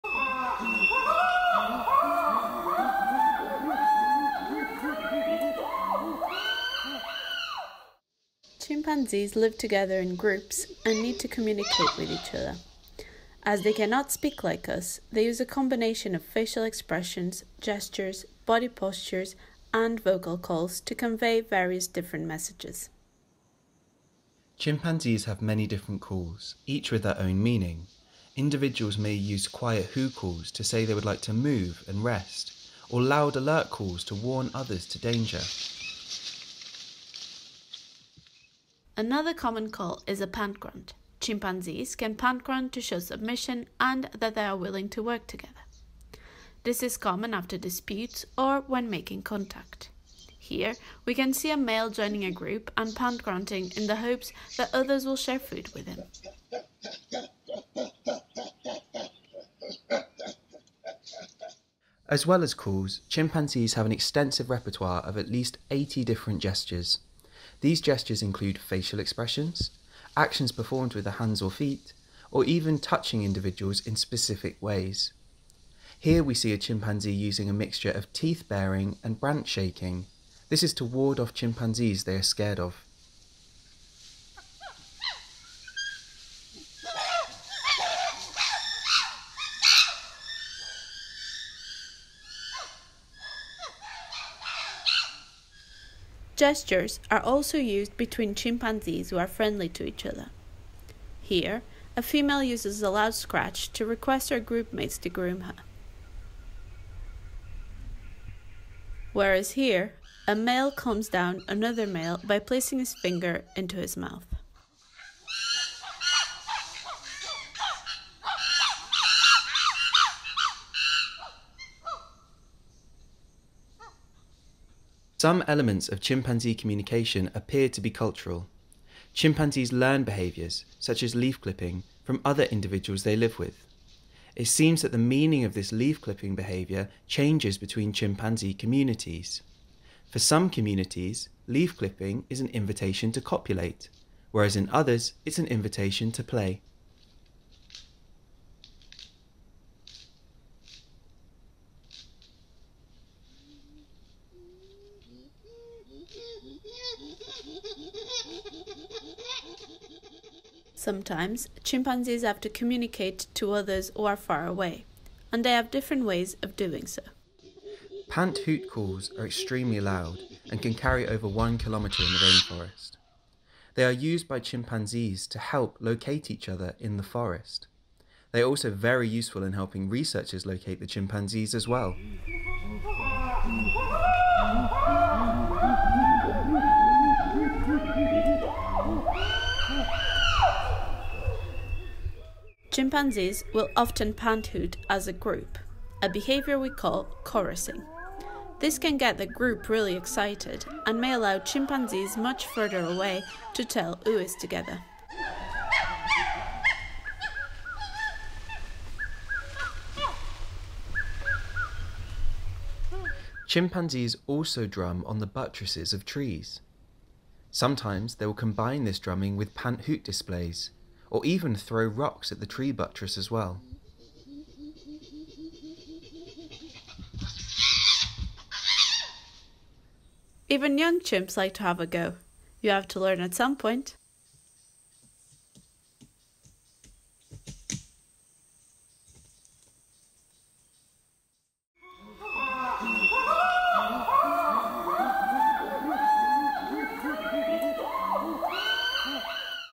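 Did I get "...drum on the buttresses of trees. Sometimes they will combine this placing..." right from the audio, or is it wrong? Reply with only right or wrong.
wrong.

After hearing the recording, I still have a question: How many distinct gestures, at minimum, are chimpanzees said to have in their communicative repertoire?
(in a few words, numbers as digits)
80.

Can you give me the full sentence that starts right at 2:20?
For some communities, leaf clipping is an invitation to copulate, whereas in others, it's an invitation to play.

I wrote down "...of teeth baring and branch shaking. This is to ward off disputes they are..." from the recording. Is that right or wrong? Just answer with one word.
wrong.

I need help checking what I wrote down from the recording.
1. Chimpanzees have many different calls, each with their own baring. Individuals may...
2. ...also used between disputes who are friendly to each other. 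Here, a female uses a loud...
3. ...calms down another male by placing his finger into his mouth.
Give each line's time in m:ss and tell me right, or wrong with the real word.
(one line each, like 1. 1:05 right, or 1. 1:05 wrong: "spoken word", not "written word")
1. 0:24 wrong: "meaning", not "baring"
2. 1:37 wrong: "chimpanzees", not "disputes"
3. 1:50 right.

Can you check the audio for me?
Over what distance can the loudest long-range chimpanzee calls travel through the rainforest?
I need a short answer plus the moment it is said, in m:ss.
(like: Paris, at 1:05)
over 1 kilometre, at 2:51.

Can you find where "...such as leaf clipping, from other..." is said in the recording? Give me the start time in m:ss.
2:10.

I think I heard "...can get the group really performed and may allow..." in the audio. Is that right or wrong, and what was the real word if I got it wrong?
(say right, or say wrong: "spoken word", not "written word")
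wrong: "excited", not "performed".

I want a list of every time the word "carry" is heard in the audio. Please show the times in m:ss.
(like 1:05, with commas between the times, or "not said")
2:50.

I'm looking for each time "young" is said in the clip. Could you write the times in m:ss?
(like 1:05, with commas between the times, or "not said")
3:50.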